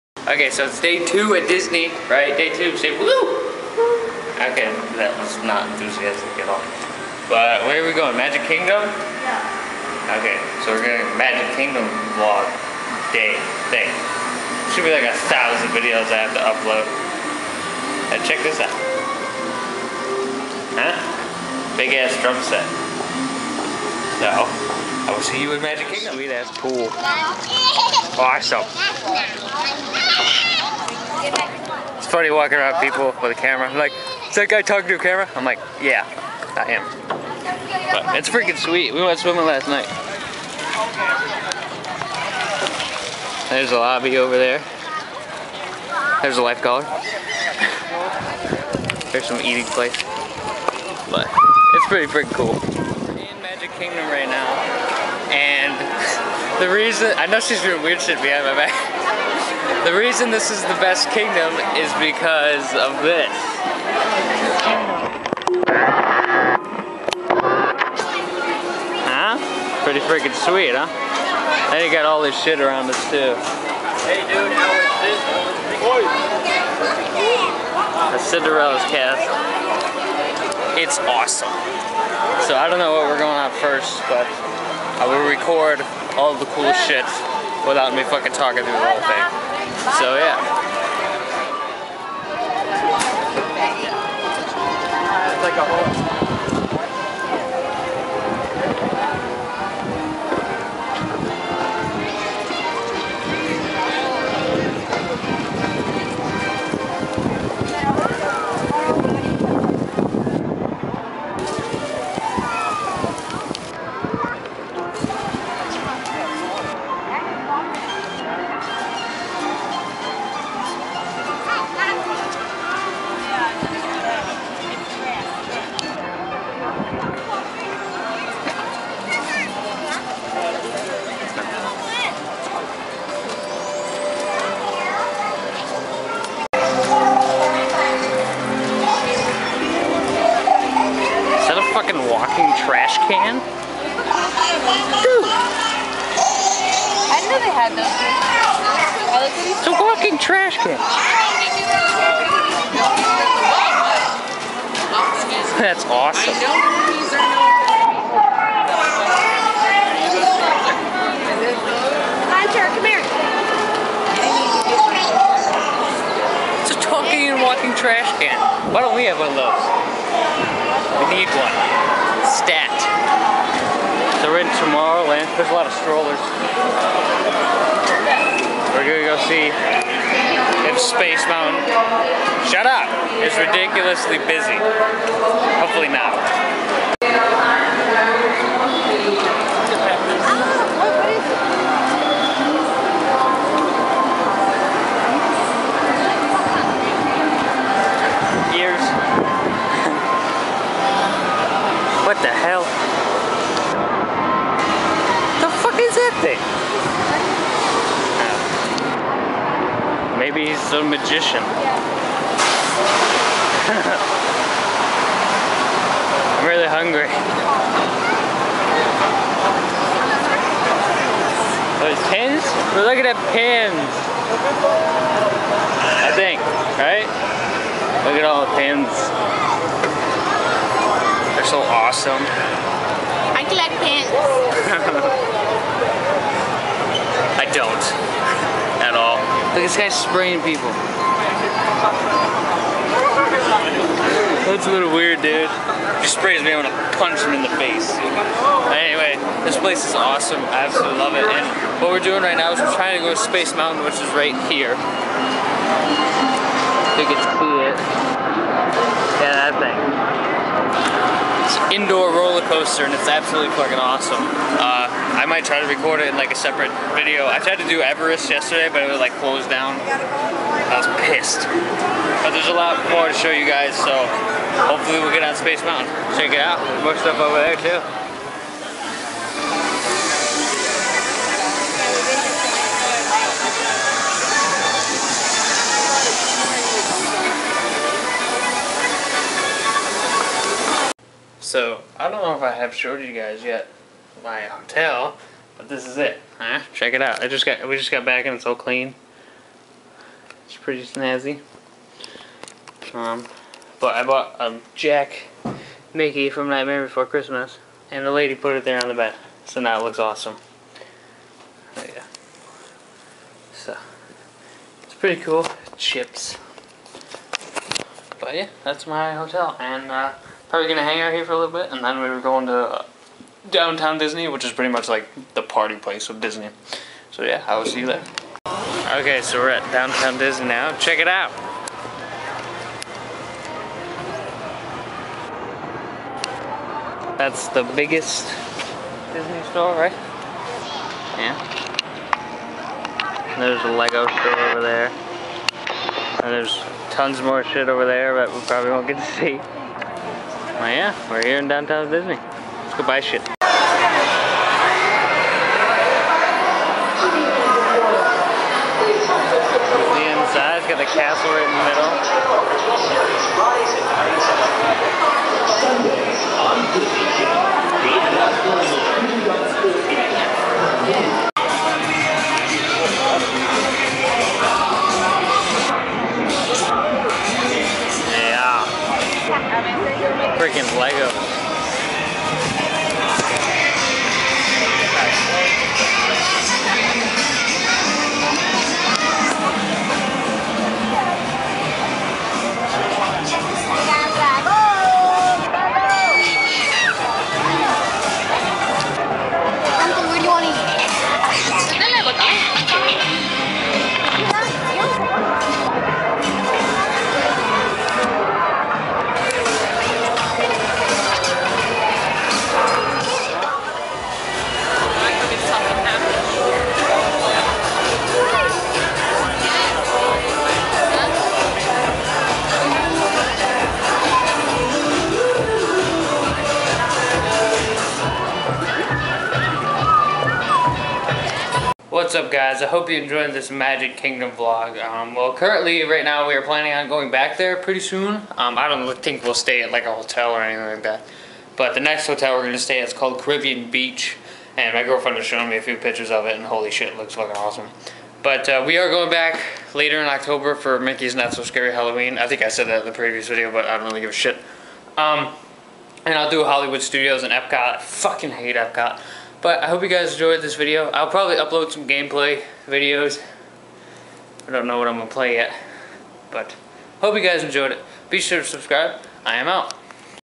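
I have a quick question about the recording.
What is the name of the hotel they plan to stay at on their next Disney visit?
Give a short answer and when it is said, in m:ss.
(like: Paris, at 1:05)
Caribbean Beach, at 7:23.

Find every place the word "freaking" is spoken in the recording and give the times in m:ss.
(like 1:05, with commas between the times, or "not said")
0:38, 0:52, 1:10.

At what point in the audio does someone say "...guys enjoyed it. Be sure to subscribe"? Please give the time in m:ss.
7:47.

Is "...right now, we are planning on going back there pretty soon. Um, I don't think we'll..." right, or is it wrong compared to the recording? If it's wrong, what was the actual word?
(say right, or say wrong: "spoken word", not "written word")
right.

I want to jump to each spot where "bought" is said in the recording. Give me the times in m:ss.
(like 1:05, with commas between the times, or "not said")
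5:04.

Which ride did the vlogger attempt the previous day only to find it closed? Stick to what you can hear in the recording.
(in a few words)
Everest.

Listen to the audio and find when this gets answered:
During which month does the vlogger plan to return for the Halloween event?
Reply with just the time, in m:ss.
7:30.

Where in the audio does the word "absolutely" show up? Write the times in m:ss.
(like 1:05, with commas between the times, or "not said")
4:10, 4:23.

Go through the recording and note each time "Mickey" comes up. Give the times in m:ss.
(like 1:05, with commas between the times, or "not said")
5:05, 7:30.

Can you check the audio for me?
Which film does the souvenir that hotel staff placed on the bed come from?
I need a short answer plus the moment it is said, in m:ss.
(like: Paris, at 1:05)
Nightmare Before Christmas, at 5:06.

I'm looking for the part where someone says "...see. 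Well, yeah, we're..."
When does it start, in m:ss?
5:49.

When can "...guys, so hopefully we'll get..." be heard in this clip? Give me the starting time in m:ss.
4:33.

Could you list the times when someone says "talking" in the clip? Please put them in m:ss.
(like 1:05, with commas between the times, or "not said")
0:34, 1:28, 2:46.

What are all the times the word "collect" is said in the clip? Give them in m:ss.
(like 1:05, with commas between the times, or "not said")
3:53.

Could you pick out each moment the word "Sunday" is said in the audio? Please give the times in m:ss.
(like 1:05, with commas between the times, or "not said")
6:06.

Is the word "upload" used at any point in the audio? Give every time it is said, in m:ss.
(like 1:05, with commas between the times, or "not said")
0:16, 7:41.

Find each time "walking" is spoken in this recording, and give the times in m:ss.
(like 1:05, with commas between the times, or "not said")
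0:32, 2:29, 2:47.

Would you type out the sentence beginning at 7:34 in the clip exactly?
Um, and I'll do Hollywood Studios and Epcot.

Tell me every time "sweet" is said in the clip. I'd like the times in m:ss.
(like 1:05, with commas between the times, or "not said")
0:38, 1:10.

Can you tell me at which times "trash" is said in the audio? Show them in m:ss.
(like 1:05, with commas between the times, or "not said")
2:30, 2:47.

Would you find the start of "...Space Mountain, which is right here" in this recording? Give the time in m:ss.
4:13.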